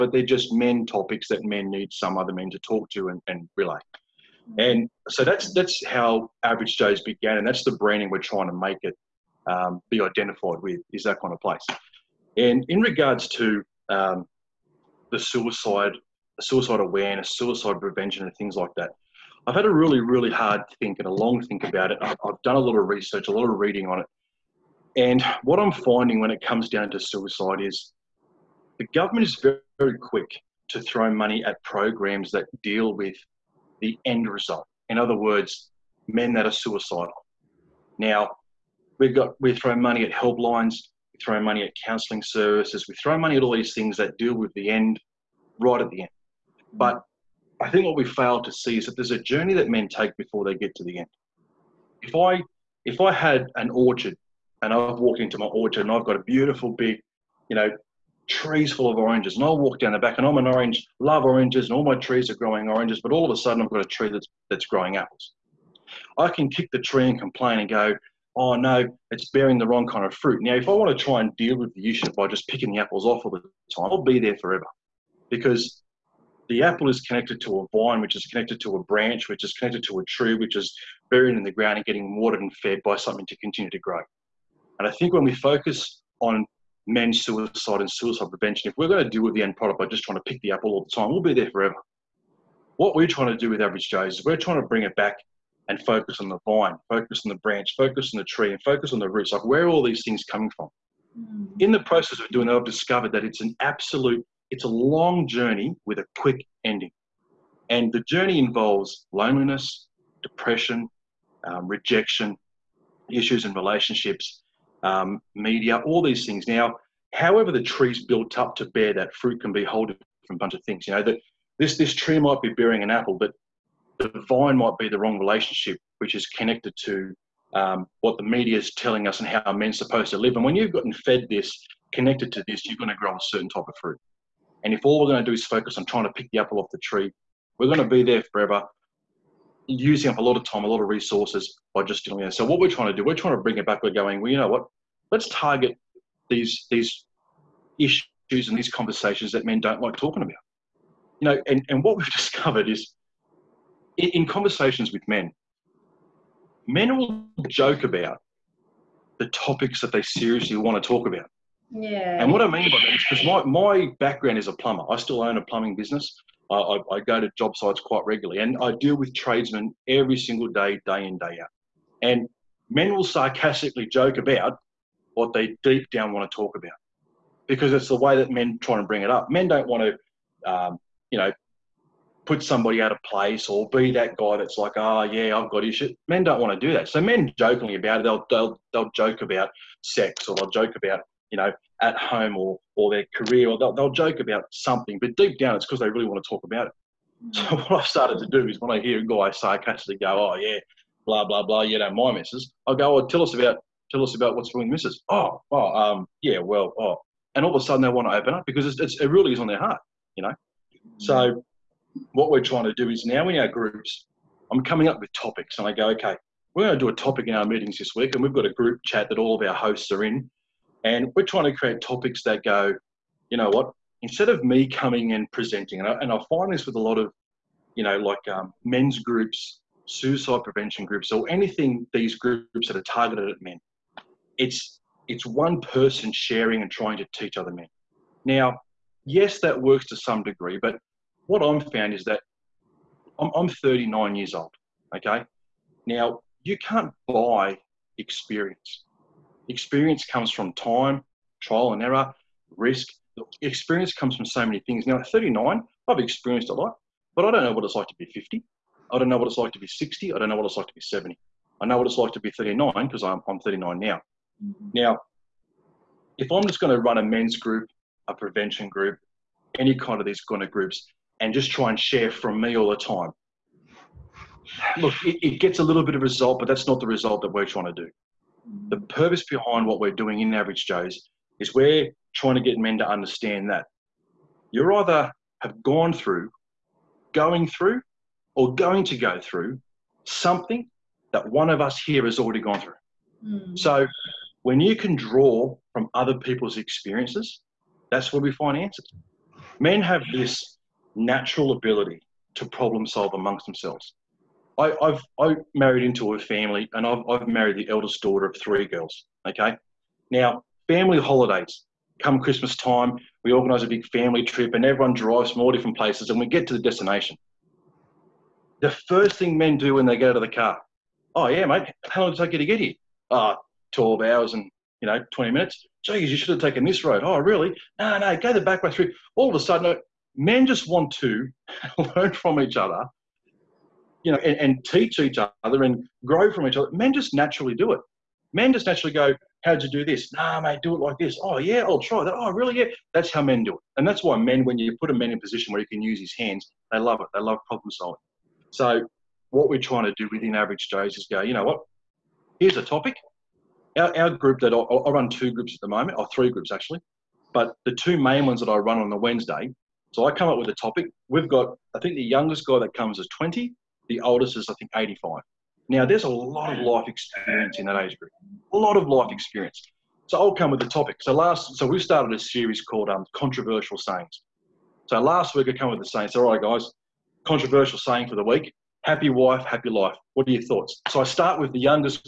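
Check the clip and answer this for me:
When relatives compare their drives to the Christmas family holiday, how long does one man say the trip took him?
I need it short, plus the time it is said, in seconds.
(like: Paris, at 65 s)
12 hours and 20 minutes, at 323 s.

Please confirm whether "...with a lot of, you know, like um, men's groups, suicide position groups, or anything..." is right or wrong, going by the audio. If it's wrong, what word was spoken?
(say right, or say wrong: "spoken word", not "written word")
wrong: "prevention", not "position".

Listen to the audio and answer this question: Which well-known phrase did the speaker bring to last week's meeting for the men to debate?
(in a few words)
happy wife, happy life.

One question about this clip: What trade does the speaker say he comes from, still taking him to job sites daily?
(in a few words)
plumber.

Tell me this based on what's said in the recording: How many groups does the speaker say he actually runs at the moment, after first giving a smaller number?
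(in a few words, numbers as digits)
3.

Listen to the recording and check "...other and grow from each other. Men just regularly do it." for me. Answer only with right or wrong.
wrong.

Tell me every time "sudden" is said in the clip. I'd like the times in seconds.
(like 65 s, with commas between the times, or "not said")
63 s, 207 s, 329 s.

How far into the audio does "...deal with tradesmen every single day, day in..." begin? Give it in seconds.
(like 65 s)
168 s.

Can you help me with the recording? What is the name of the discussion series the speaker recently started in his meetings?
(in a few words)
controversial sayings.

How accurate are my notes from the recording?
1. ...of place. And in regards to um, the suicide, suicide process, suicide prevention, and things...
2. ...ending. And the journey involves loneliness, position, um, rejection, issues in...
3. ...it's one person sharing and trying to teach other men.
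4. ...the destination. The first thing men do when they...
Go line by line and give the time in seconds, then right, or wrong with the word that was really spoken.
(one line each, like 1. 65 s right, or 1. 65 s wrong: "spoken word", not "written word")
1. 11 s wrong: "awareness", not "process"
2. 106 s wrong: "depression", not "position"
3. 235 s right
4. 316 s right.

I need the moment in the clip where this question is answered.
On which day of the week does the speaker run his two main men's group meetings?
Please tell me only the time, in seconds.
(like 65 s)
358 s.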